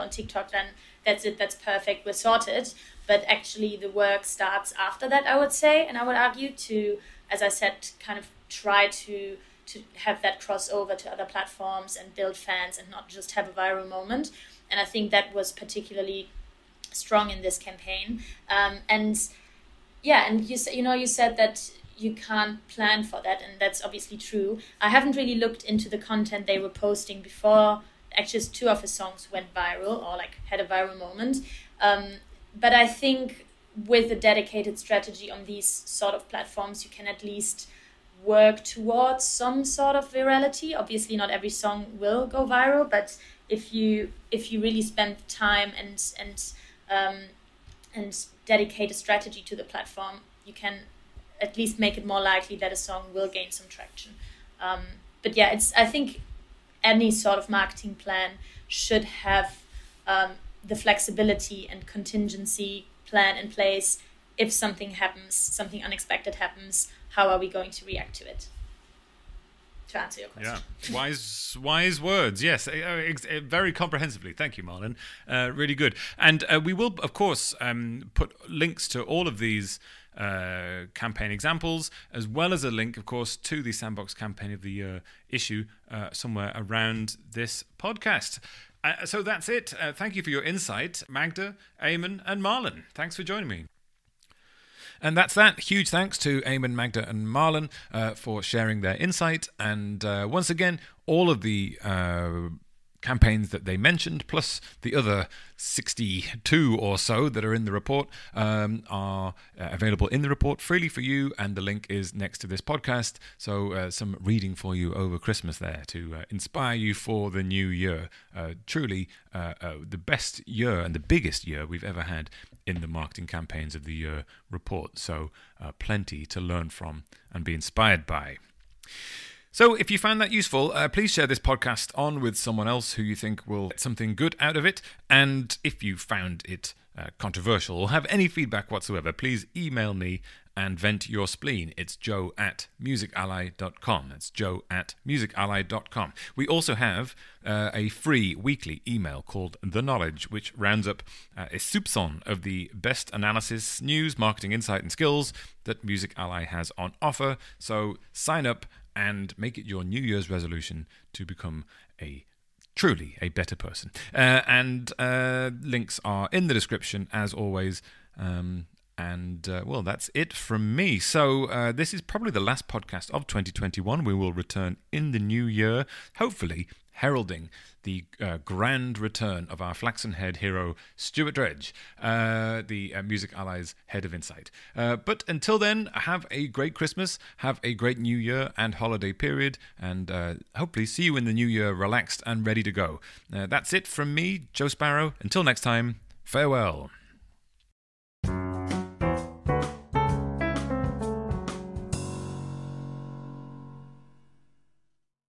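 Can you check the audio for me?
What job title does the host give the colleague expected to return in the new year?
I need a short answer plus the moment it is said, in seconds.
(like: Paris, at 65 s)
Head of Insight, at 183 s.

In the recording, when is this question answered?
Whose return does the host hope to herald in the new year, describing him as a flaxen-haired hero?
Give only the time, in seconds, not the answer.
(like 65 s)
180 s.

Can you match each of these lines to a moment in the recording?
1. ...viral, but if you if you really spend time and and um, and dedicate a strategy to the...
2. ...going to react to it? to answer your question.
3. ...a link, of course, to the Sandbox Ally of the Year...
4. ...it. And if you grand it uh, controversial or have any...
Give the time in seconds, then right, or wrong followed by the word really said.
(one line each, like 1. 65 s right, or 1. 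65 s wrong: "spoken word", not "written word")
1. 42 s right
2. 67 s right
3. 82 s wrong: "Campaign", not "Ally"
4. 134 s wrong: "found", not "grand".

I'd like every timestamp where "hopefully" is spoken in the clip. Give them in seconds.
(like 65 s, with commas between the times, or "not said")
176 s, 190 s.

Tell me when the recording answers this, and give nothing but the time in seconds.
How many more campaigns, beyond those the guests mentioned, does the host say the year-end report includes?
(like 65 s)
105 s.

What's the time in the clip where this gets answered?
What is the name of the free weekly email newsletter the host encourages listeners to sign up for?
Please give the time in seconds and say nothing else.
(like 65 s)
149 s.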